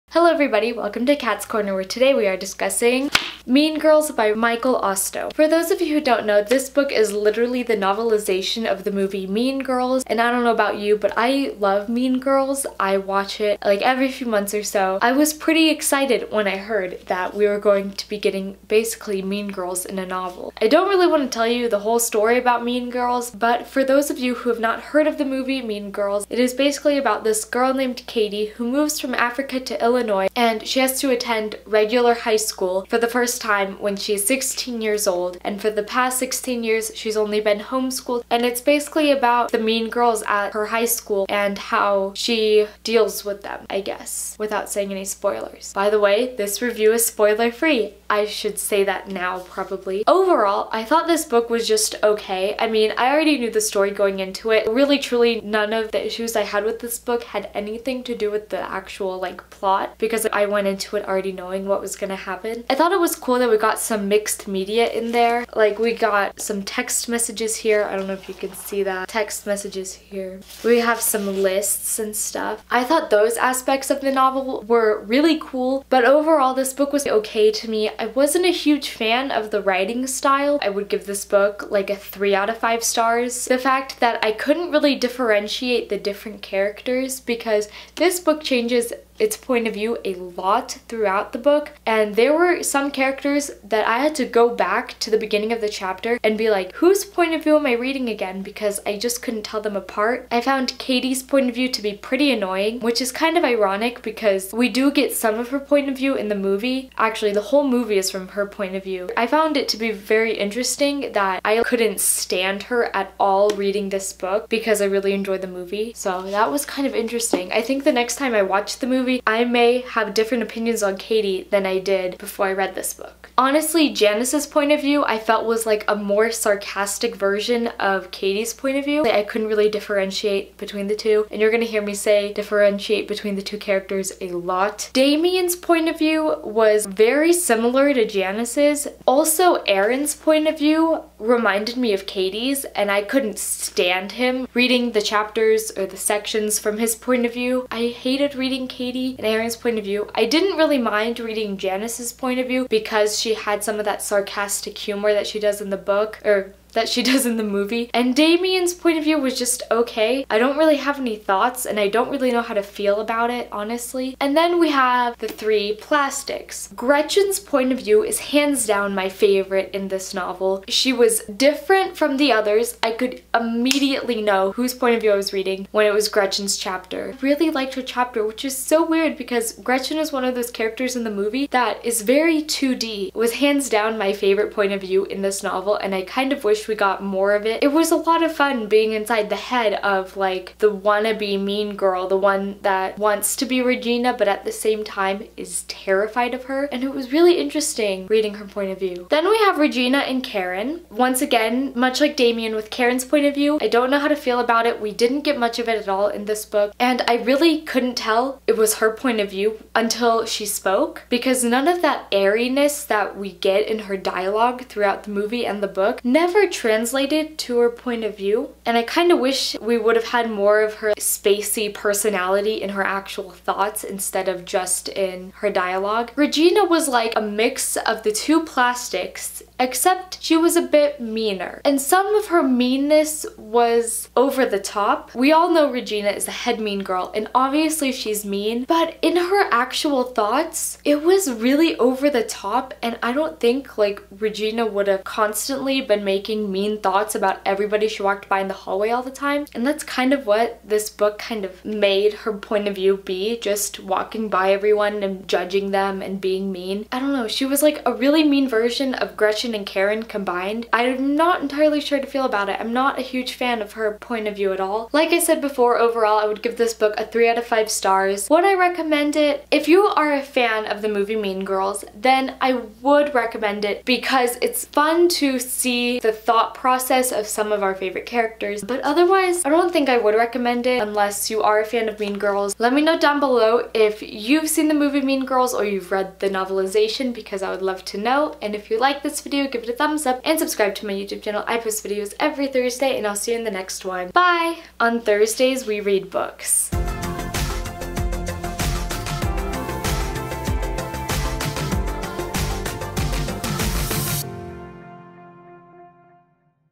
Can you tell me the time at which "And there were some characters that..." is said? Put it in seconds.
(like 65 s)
91 s.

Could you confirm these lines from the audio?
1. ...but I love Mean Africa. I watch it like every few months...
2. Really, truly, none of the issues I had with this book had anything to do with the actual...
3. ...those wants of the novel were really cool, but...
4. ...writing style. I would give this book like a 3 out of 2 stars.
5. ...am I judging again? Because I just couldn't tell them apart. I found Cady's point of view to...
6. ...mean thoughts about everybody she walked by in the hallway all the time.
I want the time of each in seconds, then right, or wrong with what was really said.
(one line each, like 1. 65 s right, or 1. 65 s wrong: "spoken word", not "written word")
1. 10 s wrong: "Girls", not "Africa"
2. 54 s right
3. 73 s wrong: "aspects", not "wants"
4. 79 s wrong: "5", not "2"
5. 97 s wrong: "reading", not "judging"
6. 246 s right.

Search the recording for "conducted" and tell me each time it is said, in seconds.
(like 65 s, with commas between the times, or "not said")
not said.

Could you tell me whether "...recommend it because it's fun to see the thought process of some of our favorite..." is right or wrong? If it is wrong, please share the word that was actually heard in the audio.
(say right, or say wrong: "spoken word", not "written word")
right.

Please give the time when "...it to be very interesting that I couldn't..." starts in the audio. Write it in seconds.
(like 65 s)
109 s.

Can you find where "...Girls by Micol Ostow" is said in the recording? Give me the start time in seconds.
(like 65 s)
3 s.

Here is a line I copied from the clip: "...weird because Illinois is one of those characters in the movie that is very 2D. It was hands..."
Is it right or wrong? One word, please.
wrong.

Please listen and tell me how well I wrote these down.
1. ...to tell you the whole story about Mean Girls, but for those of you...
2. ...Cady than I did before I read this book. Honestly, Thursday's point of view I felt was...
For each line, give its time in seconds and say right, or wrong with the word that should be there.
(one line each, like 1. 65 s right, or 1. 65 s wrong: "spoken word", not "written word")
1. 21 s right
2. 120 s wrong: "Janis", not "Thursday".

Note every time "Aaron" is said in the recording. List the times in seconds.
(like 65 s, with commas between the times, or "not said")
139 s, 149 s.